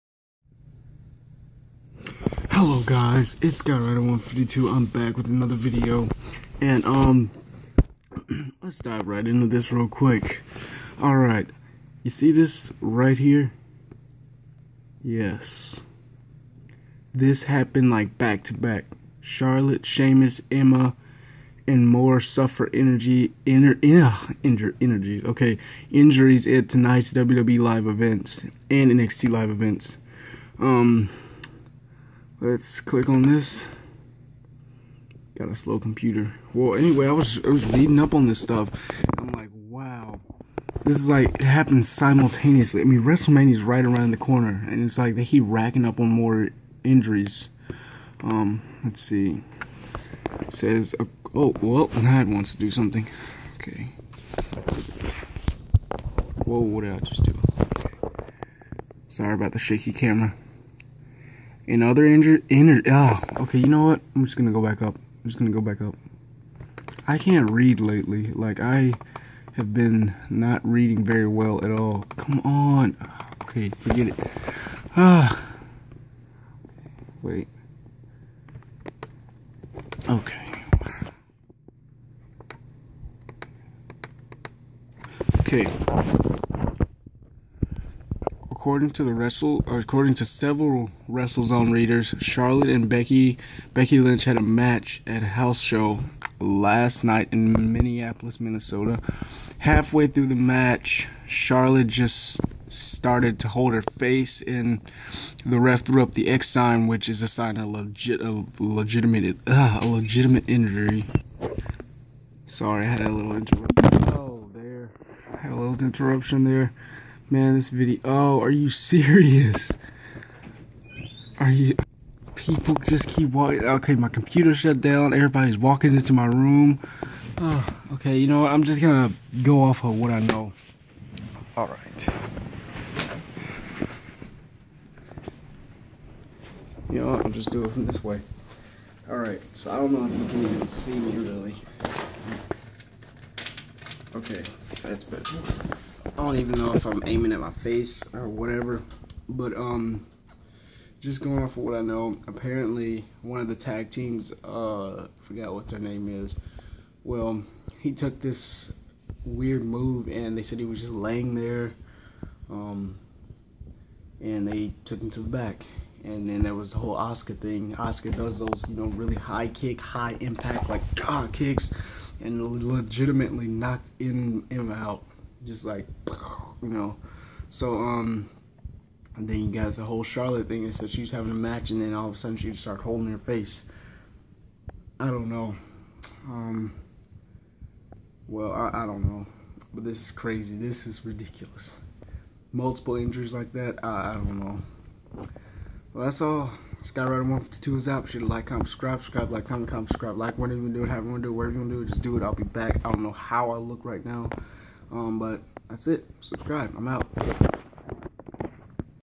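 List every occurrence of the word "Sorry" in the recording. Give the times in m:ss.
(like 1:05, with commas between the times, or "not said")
0:59, 1:52.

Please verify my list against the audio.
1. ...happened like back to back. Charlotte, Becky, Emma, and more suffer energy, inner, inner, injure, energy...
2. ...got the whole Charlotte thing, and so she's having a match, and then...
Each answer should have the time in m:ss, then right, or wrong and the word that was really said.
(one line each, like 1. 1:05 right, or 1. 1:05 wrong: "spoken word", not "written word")
1. 0:17 wrong: "Seamus", not "Becky"
2. 2:59 right.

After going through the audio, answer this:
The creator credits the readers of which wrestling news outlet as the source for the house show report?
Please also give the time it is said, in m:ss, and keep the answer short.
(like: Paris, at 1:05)
WrestleZone, at 1:31.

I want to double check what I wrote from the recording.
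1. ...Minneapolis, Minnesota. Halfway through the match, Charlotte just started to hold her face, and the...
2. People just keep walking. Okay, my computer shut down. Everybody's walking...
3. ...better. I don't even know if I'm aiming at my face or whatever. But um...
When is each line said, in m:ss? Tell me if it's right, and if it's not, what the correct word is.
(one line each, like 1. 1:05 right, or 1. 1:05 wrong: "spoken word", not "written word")
1. 1:37 right
2. 2:02 right
3. 2:25 right.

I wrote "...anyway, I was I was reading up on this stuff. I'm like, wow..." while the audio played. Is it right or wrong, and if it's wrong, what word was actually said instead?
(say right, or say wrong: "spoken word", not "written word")
right.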